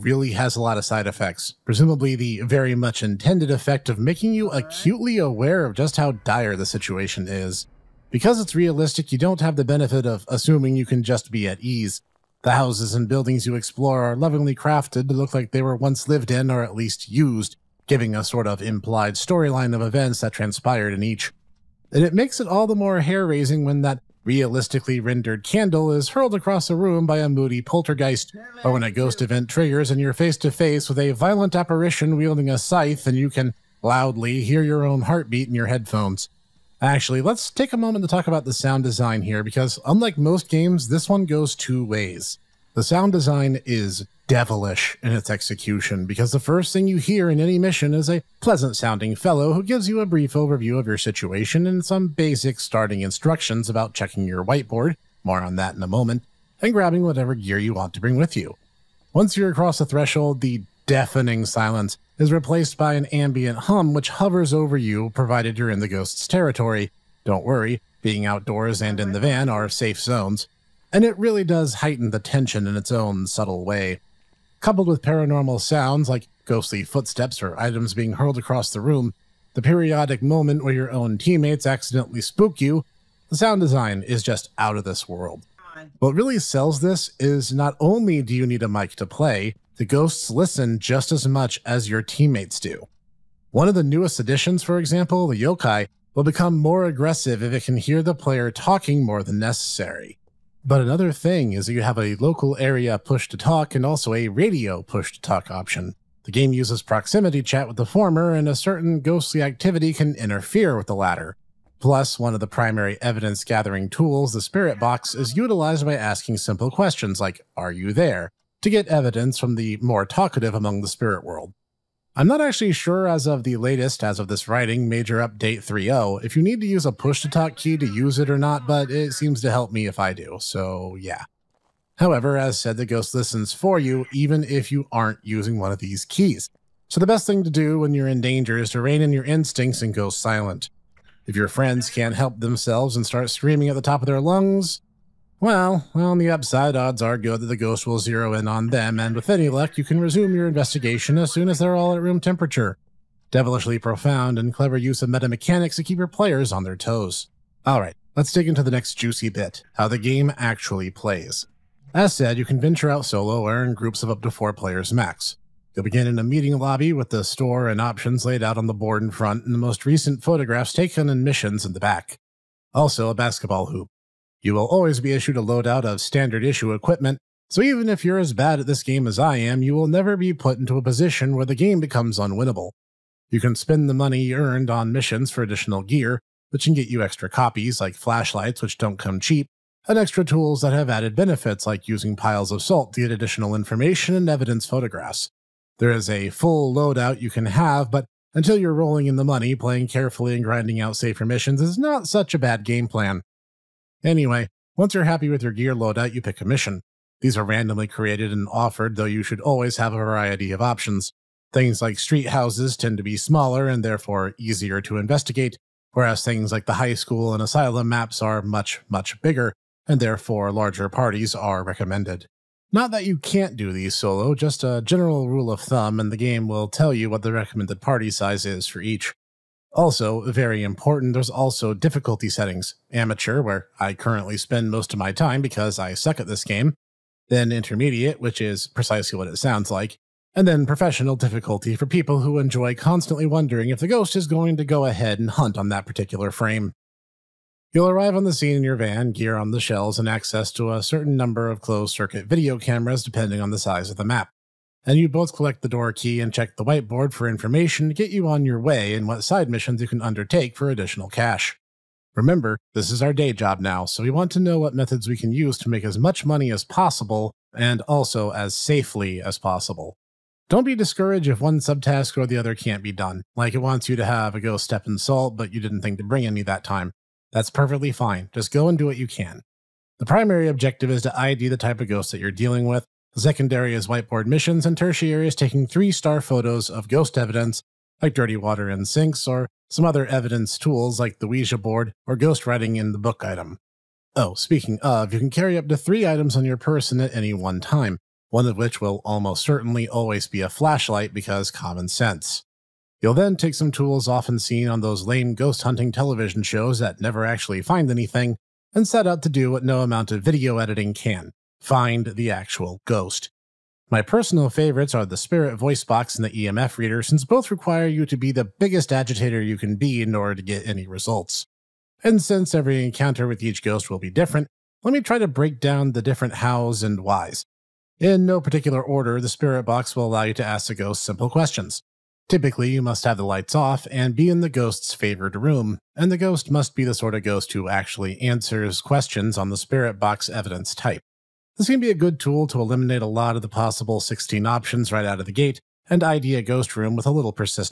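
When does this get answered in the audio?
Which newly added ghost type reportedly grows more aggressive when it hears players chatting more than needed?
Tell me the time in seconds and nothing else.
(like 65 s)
95 s.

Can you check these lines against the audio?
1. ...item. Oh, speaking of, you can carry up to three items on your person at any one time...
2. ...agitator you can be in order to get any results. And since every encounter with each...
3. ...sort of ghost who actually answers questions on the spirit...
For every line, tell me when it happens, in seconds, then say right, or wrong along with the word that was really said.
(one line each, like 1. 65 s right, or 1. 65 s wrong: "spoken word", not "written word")
1. 293 s right
2. 318 s right
3. 336 s right.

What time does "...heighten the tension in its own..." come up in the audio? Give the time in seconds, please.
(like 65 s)
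71 s.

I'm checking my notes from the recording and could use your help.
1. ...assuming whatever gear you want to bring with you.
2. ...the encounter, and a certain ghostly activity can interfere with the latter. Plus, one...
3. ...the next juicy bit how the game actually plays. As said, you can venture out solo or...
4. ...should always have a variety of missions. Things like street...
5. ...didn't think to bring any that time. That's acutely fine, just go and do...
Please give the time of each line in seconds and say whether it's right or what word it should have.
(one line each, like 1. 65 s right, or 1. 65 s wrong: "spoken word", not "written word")
1. 56 s wrong: "grabbing", not "assuming"
2. 107 s wrong: "former", not "encounter"
3. 158 s right
4. 209 s wrong: "options", not "missions"
5. 275 s wrong: "perfectly", not "acutely".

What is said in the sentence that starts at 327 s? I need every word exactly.
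In no particular order, the spirit box will allow you to ask the ghost simple questions.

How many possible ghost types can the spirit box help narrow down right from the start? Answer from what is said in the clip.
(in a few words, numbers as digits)
16.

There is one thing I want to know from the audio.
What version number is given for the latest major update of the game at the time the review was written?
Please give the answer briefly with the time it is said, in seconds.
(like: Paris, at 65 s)
3.0, at 125 s.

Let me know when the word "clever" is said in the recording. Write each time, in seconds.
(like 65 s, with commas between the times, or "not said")
154 s.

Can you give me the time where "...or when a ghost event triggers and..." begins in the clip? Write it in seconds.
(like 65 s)
28 s.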